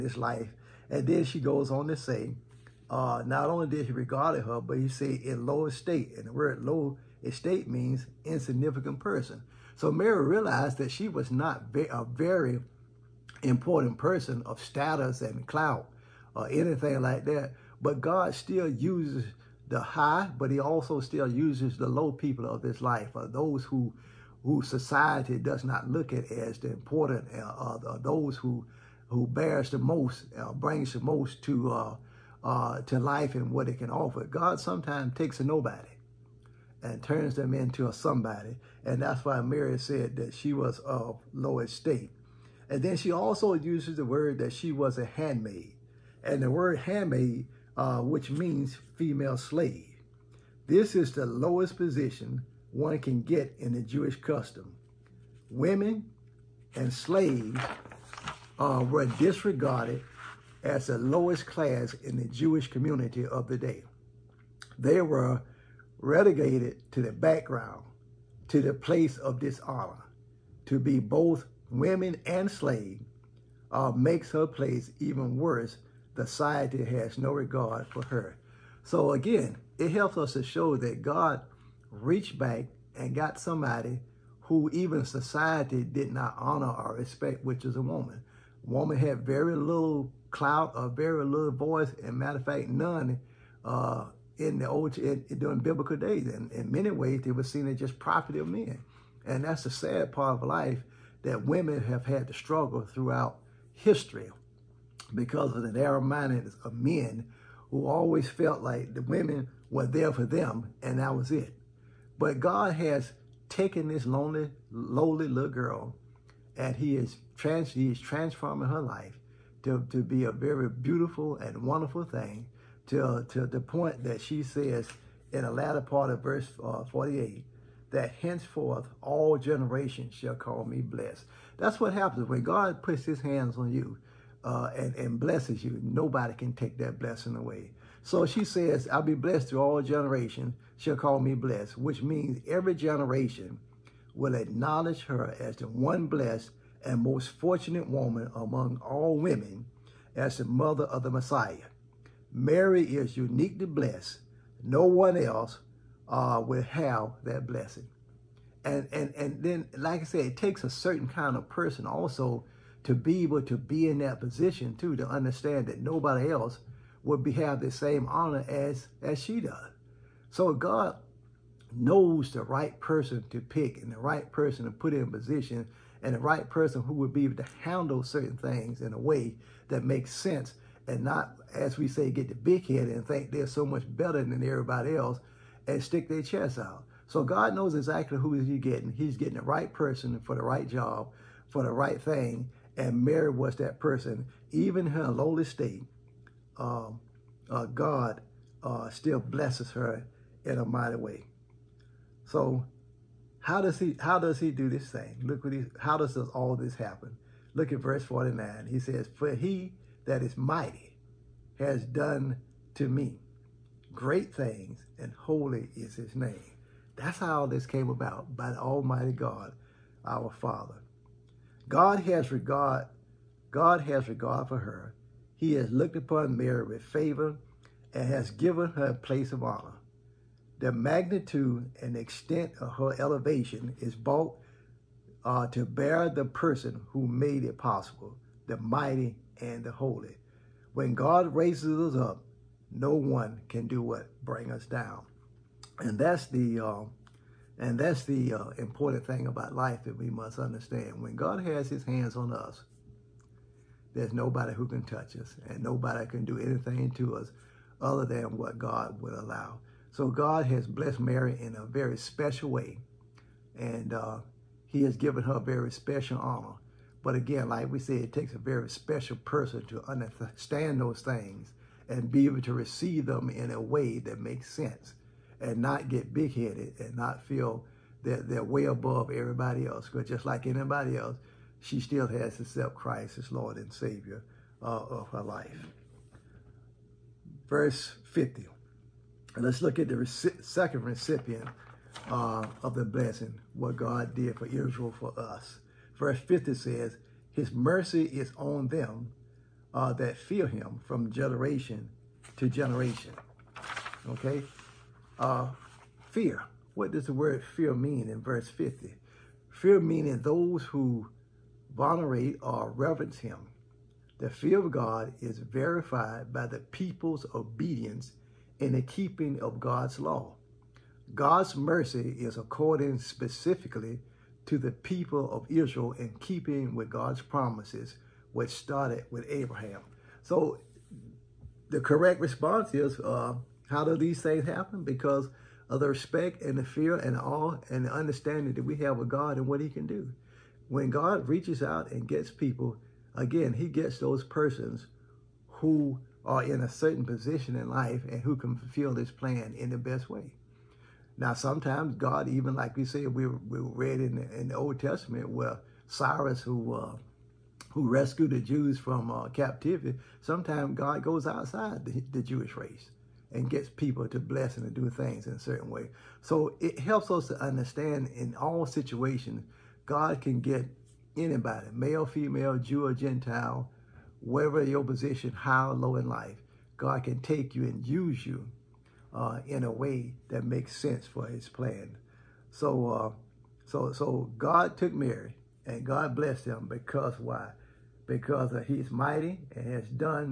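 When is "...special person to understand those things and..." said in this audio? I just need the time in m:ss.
4:28.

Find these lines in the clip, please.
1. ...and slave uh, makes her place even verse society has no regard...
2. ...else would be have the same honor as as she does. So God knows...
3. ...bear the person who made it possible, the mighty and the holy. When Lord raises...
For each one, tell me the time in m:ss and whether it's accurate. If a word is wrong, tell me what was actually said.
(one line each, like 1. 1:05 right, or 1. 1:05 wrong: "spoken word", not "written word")
1. 1:12 wrong: "worse", not "verse"
2. 2:46 right
3. 3:55 wrong: "God", not "Lord".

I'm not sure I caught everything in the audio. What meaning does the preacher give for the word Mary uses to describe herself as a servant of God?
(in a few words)
Female slave.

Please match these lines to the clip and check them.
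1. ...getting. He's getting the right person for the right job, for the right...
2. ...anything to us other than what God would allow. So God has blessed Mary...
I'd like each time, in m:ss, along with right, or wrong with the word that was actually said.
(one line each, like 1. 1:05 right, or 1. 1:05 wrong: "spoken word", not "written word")
1. 3:08 right
2. 4:16 right.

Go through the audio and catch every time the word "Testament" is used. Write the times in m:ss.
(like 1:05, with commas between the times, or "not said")
5:54.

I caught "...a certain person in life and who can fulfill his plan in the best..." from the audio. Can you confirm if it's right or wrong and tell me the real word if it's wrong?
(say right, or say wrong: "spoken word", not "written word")
wrong: "position", not "person".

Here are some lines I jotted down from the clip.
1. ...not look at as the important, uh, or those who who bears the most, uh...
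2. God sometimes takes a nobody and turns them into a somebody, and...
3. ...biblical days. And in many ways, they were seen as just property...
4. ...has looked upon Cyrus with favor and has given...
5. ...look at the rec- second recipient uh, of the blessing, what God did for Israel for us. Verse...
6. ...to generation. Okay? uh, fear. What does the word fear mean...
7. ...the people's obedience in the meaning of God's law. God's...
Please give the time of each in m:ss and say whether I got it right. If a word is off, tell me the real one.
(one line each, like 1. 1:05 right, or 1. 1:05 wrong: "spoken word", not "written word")
1. 0:25 right
2. 0:34 right
3. 1:35 right
4. 3:45 wrong: "Mary", not "Cyrus"
5. 4:49 right
6. 5:02 right
7. 5:16 wrong: "keeping", not "meaning".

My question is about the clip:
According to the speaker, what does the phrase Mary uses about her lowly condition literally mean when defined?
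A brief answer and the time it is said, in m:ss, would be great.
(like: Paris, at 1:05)
Insignificant person, at 0:08.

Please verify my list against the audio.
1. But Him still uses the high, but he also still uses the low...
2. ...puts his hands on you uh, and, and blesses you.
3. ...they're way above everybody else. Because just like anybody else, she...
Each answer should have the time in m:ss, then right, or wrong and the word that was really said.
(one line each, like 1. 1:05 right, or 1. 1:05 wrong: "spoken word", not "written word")
1. 0:17 wrong: "God", not "Him"
2. 2:12 right
3. 4:38 right.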